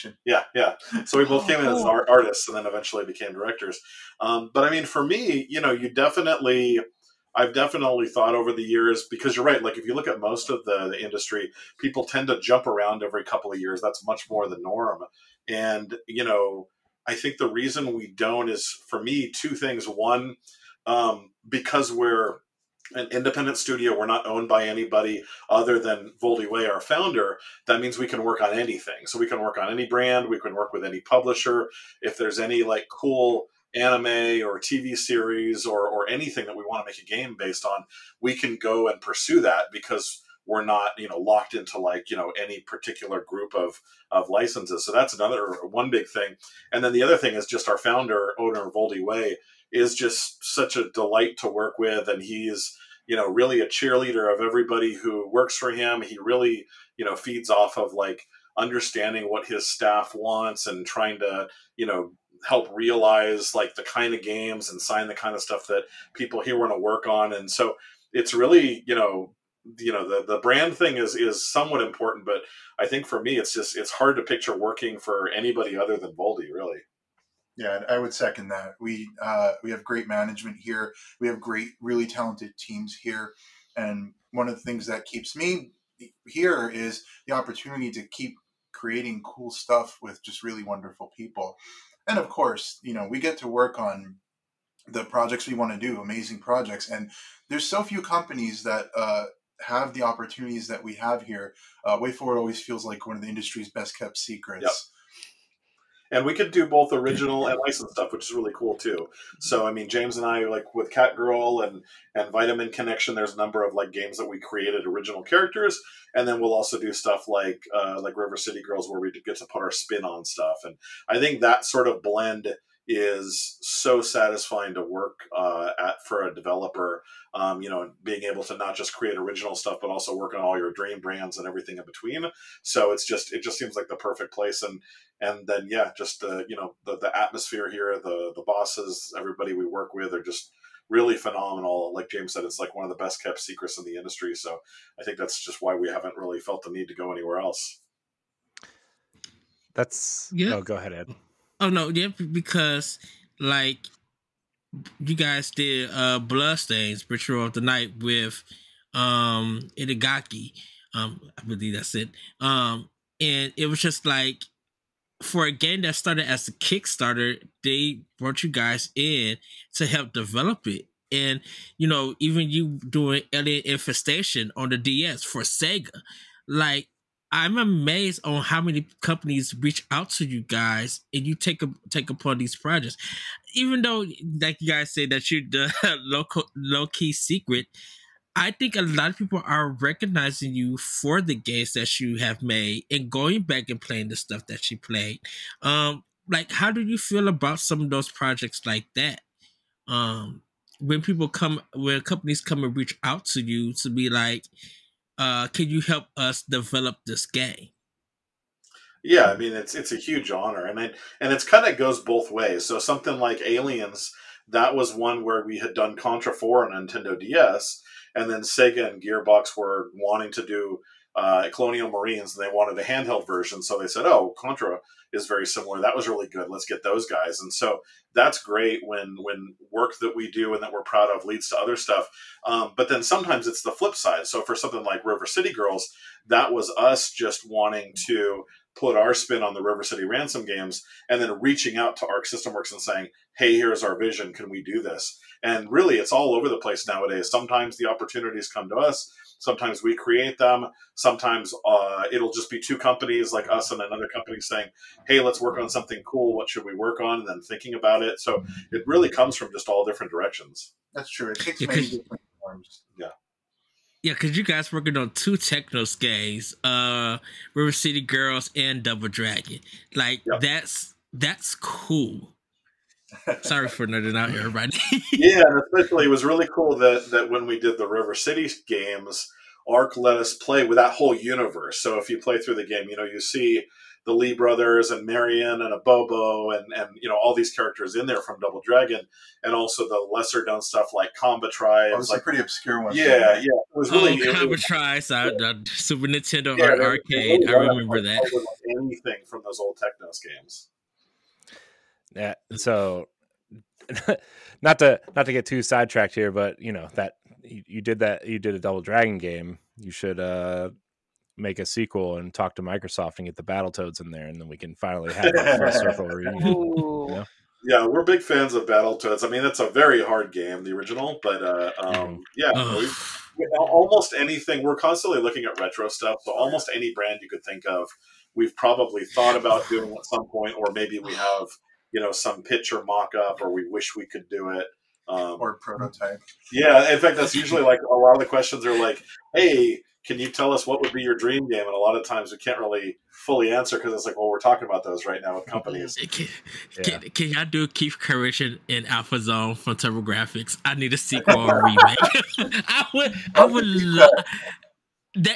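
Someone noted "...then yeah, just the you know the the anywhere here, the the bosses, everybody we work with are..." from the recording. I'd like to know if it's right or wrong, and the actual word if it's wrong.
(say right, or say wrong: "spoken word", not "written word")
wrong: "atmosphere", not "anywhere".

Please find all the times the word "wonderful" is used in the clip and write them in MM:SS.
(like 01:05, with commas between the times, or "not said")
01:30.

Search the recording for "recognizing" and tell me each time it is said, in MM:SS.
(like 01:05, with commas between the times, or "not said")
03:09.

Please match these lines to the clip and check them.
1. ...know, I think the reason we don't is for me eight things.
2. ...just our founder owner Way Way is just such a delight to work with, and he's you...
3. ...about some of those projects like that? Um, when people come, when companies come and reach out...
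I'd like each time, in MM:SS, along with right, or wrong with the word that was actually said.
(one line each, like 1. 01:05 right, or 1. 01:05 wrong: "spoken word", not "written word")
1. 00:16 wrong: "two", not "eight"
2. 00:47 wrong: "Voldi", not "Way"
3. 03:17 right.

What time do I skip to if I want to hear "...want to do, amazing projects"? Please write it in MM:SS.
01:35.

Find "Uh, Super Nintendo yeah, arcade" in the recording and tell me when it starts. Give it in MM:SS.
04:55.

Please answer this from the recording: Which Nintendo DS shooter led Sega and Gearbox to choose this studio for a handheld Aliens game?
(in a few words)
Contra 4.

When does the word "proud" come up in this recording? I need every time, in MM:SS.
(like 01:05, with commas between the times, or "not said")
03:50.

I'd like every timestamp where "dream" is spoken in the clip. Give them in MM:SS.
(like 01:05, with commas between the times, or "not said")
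02:10, 05:41.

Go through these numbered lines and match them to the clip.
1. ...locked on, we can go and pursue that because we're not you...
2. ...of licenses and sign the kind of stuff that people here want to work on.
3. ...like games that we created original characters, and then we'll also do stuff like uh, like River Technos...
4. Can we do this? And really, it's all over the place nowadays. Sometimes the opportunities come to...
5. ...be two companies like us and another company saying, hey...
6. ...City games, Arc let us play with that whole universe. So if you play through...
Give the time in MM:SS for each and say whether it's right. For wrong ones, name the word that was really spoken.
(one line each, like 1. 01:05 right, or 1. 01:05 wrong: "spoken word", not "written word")
1. 00:37 wrong: "based", not "locked"
2. 01:04 wrong: "games", not "licenses"
3. 01:53 wrong: "City", not "Technos"
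4. 04:04 right
5. 04:12 right
6. 04:38 right.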